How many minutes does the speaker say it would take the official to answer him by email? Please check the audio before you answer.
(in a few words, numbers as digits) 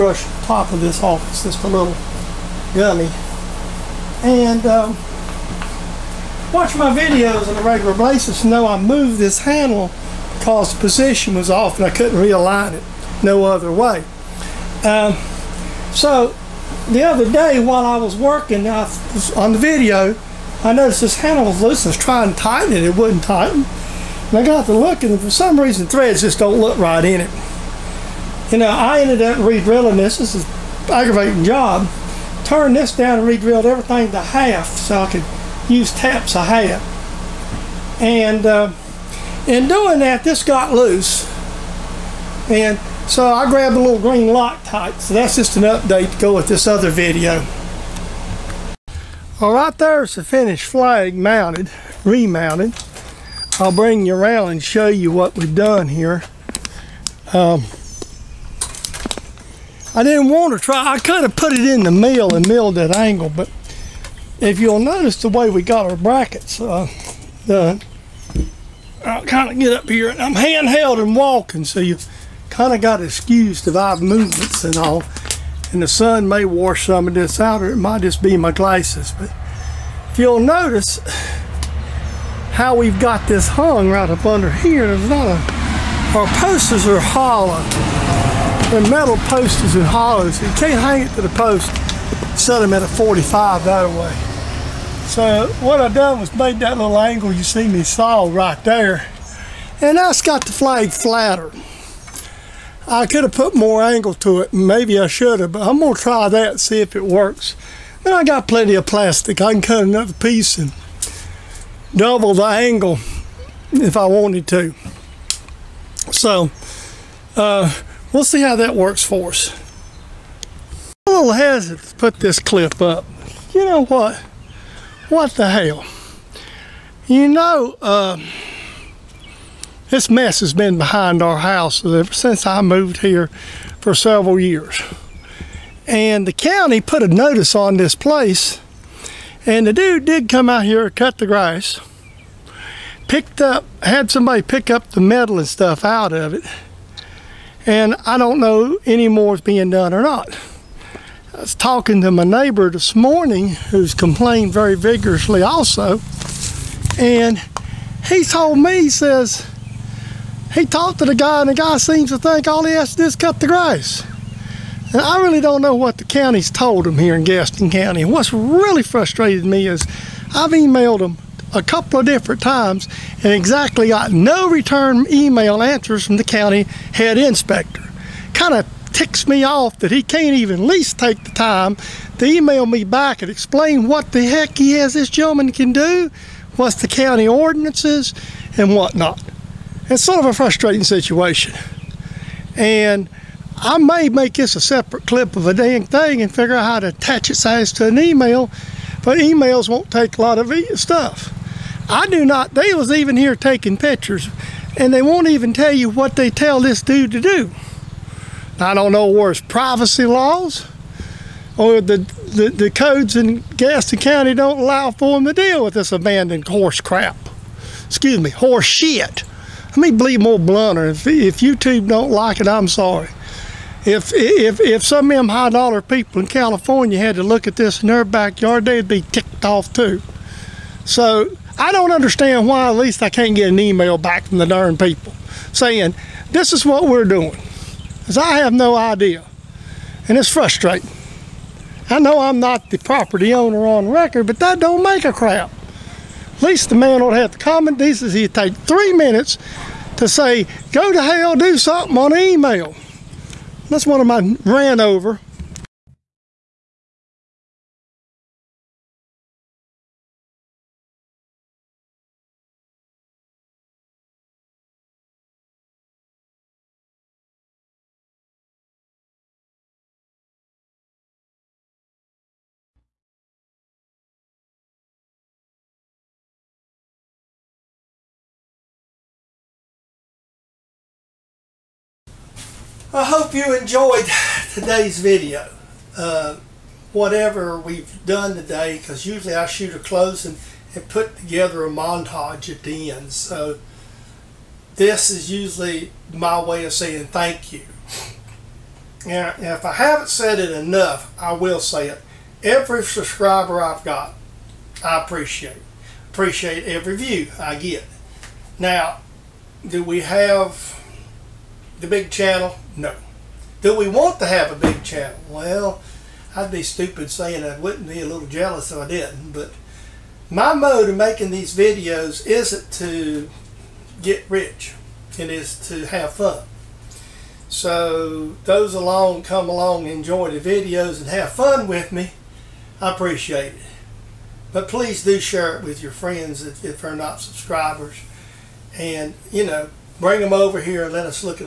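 3.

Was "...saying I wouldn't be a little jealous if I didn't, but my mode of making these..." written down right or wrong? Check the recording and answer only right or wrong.
right.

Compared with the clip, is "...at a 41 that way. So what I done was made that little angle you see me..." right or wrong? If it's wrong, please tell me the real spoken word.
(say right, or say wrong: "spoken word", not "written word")
wrong: "45", not "41".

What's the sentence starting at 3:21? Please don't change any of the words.
I do not, they was even here taking pictures and they won't even tell you what they tell this dude to do.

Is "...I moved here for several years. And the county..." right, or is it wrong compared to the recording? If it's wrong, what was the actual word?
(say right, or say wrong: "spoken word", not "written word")
right.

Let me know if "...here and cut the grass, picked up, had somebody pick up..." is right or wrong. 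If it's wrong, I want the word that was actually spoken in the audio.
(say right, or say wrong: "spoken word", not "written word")
right.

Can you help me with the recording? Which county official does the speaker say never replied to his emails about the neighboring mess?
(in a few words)
head inspector.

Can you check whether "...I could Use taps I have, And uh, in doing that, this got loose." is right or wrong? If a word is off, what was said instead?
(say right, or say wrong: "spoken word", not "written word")
right.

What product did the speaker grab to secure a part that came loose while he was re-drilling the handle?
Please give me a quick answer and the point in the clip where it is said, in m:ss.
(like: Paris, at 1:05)
green Loctite, at 0:43.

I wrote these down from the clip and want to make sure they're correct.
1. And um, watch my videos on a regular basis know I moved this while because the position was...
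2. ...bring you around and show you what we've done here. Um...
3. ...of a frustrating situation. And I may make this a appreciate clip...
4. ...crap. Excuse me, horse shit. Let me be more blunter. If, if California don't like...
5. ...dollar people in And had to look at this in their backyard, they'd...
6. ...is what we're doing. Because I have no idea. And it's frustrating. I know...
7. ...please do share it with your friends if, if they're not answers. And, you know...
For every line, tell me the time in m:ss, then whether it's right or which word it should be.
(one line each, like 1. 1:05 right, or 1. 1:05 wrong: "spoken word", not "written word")
1. 0:04 wrong: "handle", not "while"
2. 0:53 right
3. 3:10 wrong: "separate", not "appreciate"
4. 3:36 wrong: "YouTube", not "California"
5. 3:45 wrong: "California", not "And"
6. 3:56 right
7. 5:34 wrong: "subscribers", not "answers".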